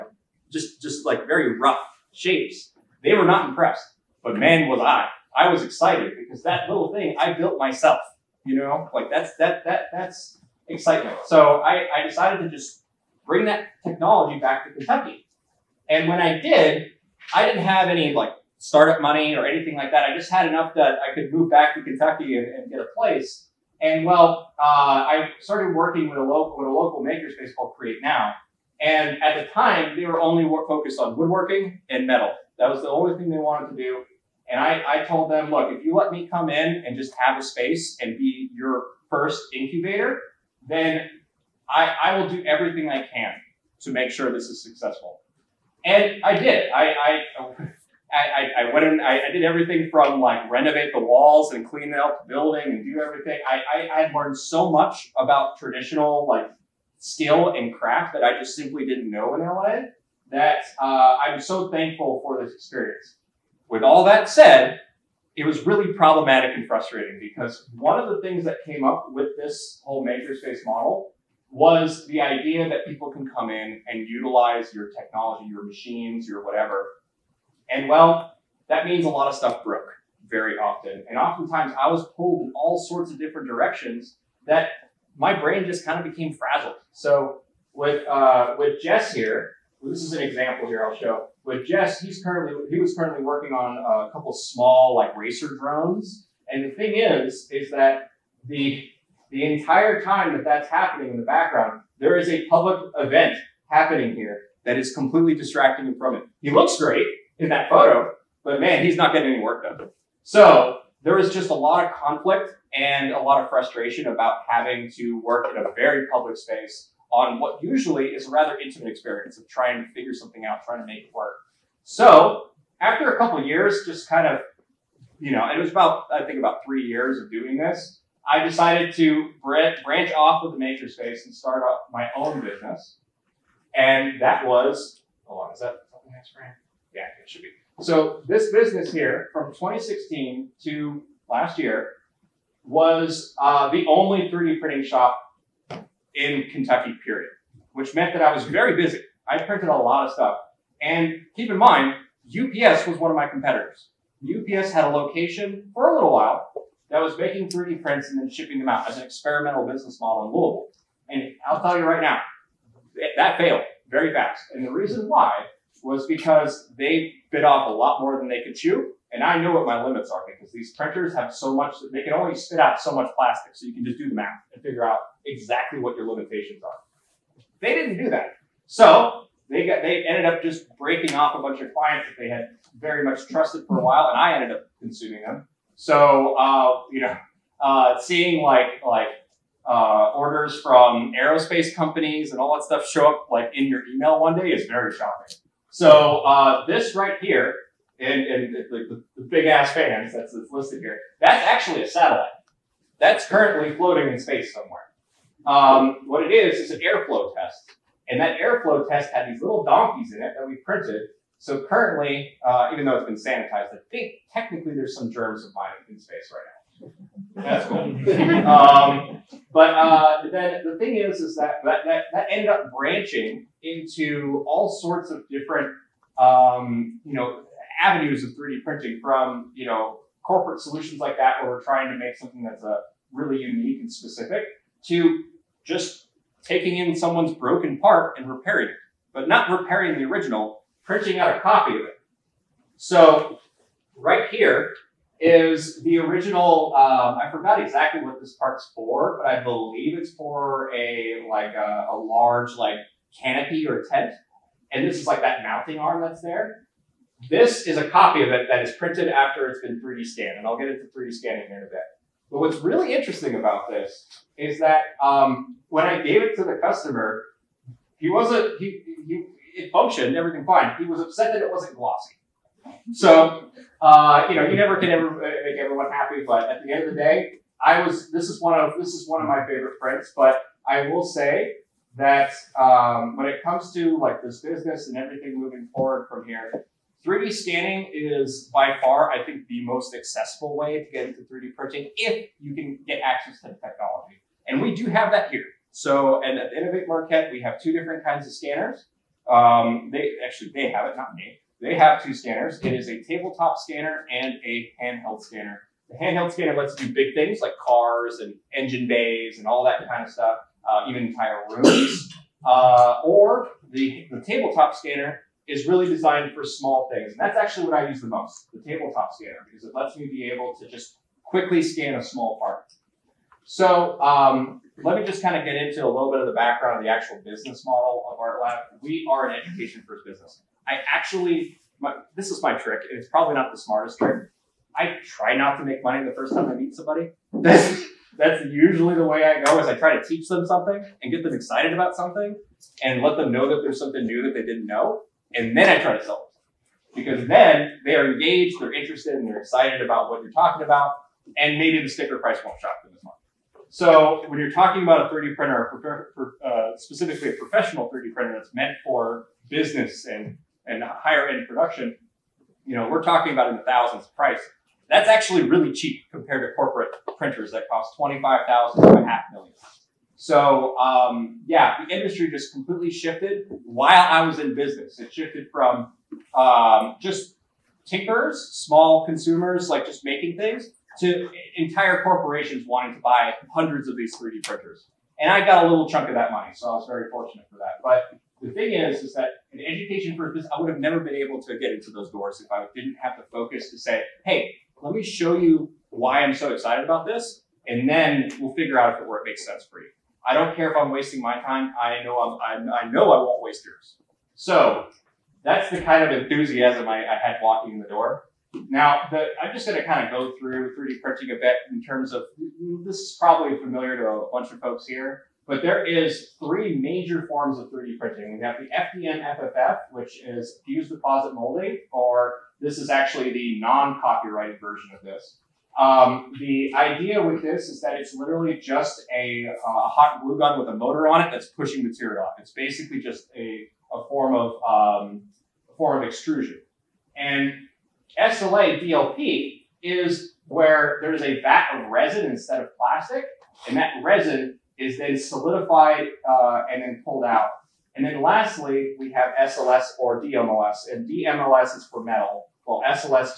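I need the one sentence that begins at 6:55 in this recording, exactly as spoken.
But there is three major forms of 3D printing.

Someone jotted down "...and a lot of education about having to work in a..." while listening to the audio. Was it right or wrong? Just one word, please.
wrong.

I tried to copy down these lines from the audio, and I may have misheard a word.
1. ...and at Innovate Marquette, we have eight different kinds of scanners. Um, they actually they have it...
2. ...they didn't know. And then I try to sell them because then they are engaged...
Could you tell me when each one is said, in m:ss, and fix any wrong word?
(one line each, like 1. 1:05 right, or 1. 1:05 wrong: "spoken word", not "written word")
1. 4:56 wrong: "two", not "eight"
2. 5:44 right.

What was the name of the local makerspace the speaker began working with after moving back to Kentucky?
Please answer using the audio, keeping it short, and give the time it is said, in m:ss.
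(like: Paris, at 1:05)
Create Now, at 0:27.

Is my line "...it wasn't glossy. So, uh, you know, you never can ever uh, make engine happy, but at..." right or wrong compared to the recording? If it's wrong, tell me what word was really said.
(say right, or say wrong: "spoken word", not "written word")
wrong: "everyone", not "engine".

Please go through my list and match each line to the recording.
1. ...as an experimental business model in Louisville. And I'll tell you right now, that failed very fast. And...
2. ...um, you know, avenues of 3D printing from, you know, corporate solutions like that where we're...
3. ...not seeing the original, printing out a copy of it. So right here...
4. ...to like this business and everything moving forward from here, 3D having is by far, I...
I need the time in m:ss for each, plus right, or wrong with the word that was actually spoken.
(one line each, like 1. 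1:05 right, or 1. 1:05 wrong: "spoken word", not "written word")
1. 2:38 right
2. 3:46 right
3. 3:59 wrong: "repairing", not "seeing"
4. 4:43 wrong: "scanning", not "having".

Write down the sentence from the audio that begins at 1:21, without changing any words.
And oftentimes I was pulled in all sorts of different directions that my brain just kind of became frazzled.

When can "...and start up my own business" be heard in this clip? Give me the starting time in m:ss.
2:11.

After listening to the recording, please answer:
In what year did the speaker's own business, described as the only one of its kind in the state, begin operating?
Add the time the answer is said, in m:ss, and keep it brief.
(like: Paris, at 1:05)
2016, at 2:19.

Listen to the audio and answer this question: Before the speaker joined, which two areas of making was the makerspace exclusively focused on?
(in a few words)
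woodworking and metal.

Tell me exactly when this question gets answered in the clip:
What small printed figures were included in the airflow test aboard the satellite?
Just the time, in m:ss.
3:29.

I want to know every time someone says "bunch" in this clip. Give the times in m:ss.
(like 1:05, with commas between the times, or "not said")
3:01, 6:54.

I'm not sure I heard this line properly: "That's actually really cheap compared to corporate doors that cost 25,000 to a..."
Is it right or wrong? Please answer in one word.
wrong.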